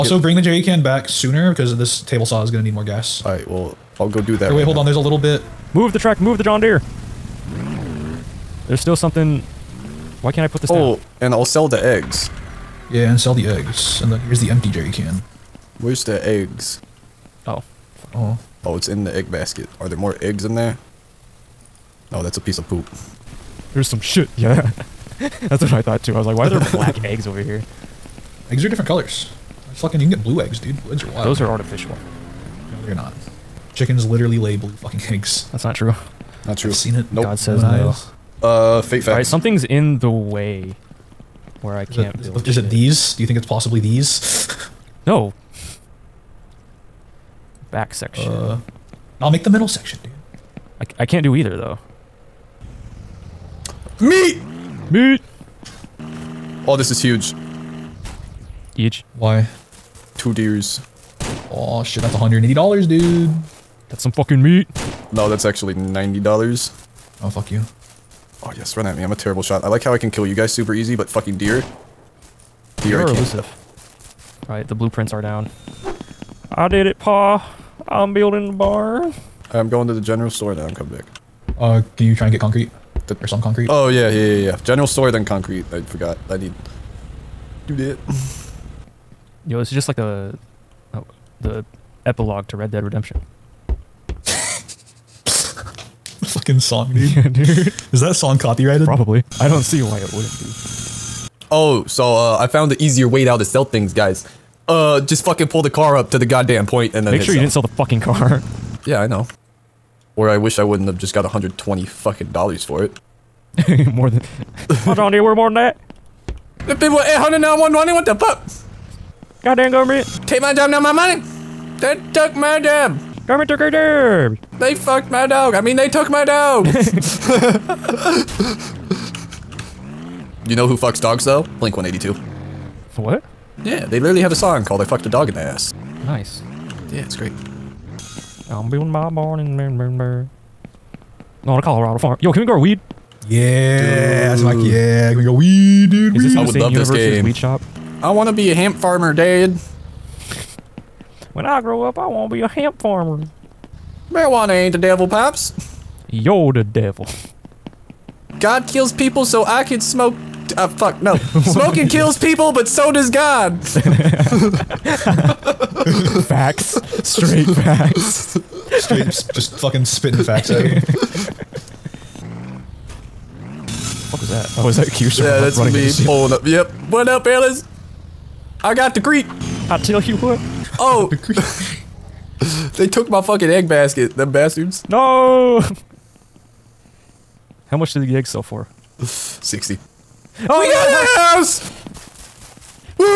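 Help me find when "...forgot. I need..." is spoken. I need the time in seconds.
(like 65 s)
85 s.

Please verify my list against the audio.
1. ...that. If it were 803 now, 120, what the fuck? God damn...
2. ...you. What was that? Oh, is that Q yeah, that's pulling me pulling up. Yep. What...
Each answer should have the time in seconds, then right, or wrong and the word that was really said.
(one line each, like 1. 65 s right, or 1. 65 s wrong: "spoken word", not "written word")
1. 115 s wrong: "800", not "803"
2. 170 s wrong: "running", not "pulling".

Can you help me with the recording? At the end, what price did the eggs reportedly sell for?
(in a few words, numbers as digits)
60.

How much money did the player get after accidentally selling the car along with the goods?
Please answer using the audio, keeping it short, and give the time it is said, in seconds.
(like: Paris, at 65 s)
$120, at 111 s.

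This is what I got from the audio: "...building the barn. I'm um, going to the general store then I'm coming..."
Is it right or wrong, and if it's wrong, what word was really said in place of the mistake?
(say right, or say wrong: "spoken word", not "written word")
right.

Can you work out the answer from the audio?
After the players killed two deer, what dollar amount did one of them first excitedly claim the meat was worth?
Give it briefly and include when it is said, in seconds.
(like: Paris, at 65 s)
$180, at 62 s.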